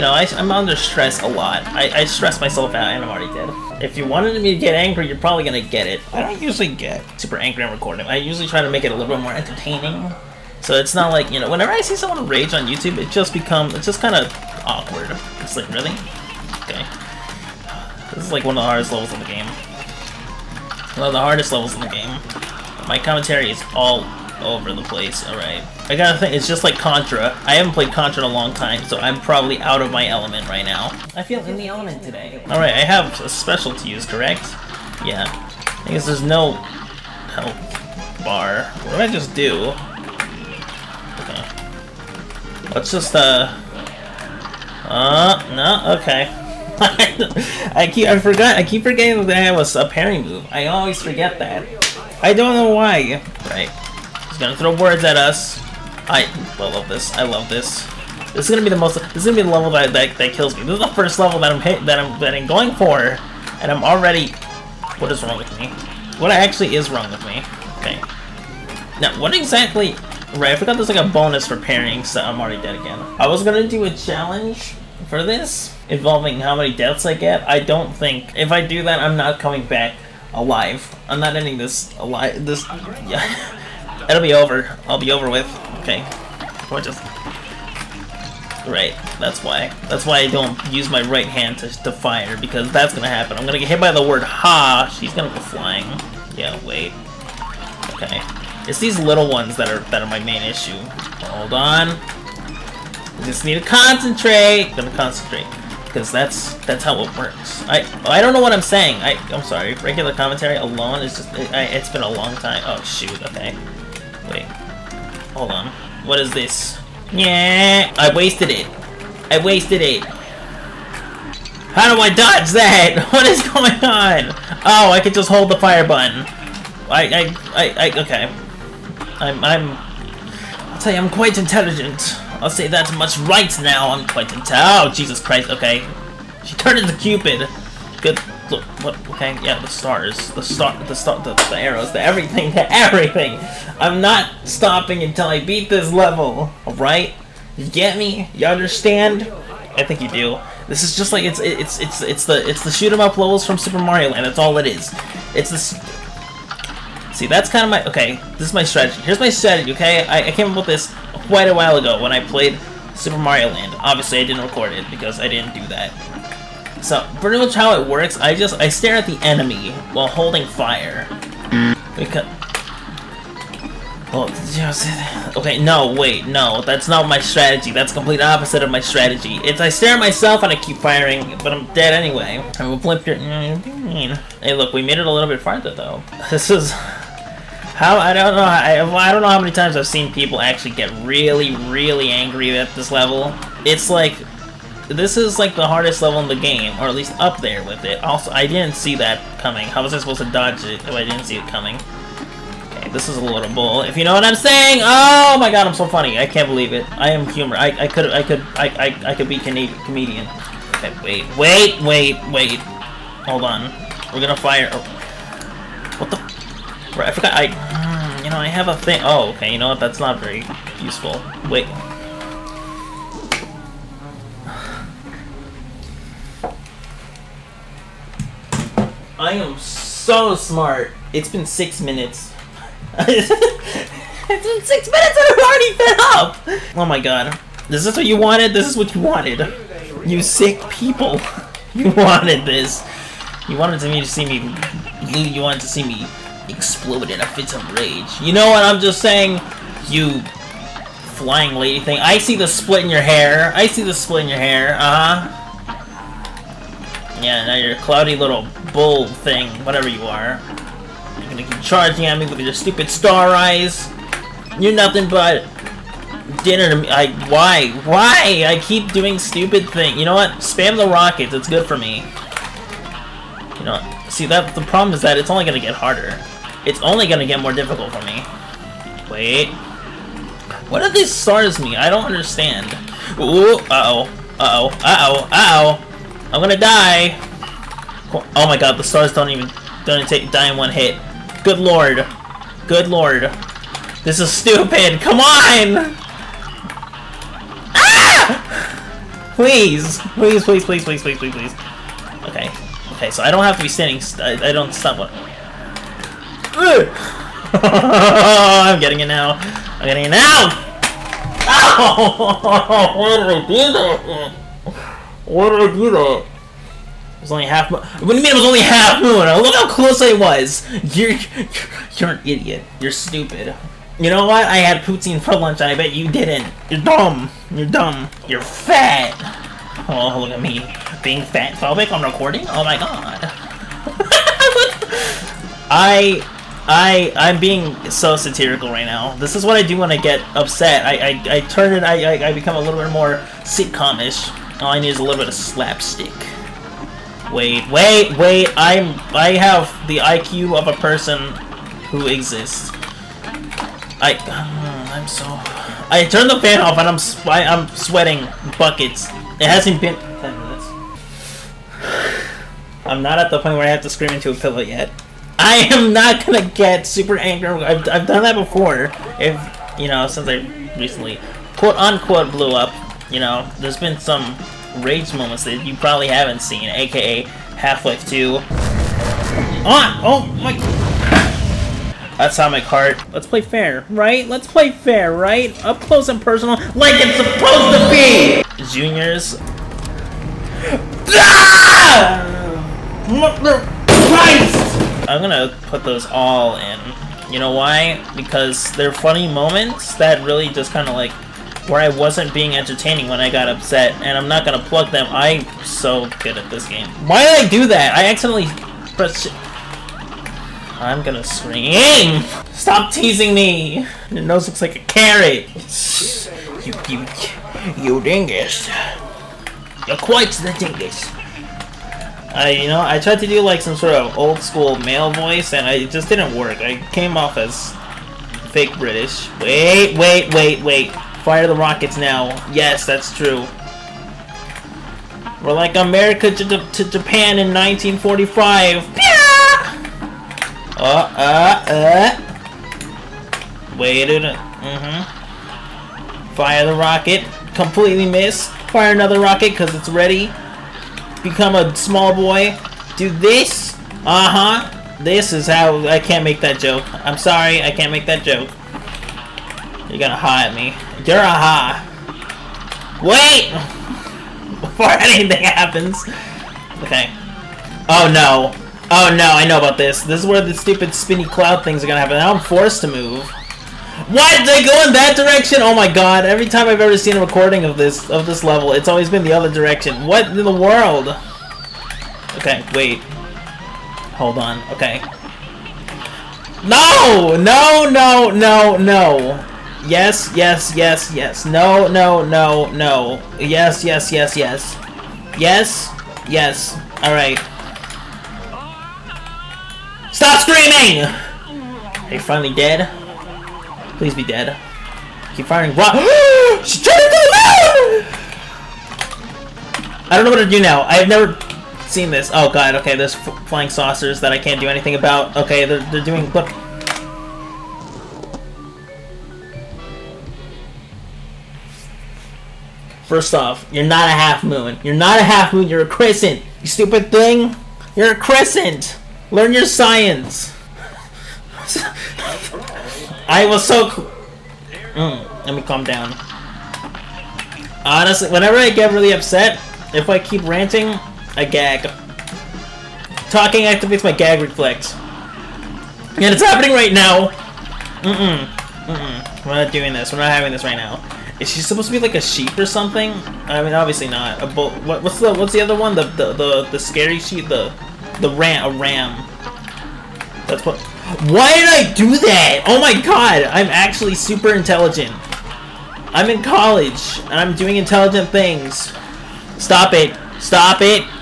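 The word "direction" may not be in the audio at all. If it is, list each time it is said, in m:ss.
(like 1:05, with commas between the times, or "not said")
7:55, 7:59.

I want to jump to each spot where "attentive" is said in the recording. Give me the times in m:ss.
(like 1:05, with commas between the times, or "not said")
not said.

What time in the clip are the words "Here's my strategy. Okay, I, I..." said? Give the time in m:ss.
2:39.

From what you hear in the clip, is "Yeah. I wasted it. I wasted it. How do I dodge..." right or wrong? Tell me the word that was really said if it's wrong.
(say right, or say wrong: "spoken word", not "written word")
right.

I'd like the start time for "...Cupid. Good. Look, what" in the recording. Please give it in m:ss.
2:16.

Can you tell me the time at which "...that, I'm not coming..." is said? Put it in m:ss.
1:18.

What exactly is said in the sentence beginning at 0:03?
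If you wanted me to get angry, you're probably gonna get it.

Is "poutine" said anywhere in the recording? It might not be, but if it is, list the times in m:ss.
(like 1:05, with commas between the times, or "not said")
5:24.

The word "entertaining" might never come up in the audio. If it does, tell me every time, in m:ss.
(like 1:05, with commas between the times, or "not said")
0:09, 6:42.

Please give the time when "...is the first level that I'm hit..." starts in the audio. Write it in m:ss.
1:00.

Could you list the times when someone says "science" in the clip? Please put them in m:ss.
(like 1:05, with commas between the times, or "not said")
8:49.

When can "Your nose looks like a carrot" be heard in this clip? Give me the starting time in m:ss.
6:54.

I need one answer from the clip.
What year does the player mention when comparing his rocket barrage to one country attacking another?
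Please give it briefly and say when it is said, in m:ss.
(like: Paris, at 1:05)
1945, at 7:17.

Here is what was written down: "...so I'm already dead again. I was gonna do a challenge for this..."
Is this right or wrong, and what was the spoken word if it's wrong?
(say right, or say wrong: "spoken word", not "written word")
right.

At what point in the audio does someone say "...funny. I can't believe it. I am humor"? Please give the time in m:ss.
3:25.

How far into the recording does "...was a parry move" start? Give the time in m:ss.
0:49.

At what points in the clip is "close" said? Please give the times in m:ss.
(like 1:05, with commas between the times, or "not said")
5:19, 6:25.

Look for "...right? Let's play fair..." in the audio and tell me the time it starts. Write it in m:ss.
6:23.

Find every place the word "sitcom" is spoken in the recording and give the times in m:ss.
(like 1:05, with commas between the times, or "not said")
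5:43.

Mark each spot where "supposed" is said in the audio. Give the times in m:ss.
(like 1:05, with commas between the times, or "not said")
3:19, 6:27, 9:11.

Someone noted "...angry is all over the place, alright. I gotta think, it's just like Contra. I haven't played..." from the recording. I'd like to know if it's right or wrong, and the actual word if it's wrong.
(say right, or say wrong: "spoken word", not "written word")
wrong: "commentary", not "angry".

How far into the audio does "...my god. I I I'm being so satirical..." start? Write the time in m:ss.
5:32.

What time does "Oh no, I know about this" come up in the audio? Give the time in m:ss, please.
7:48.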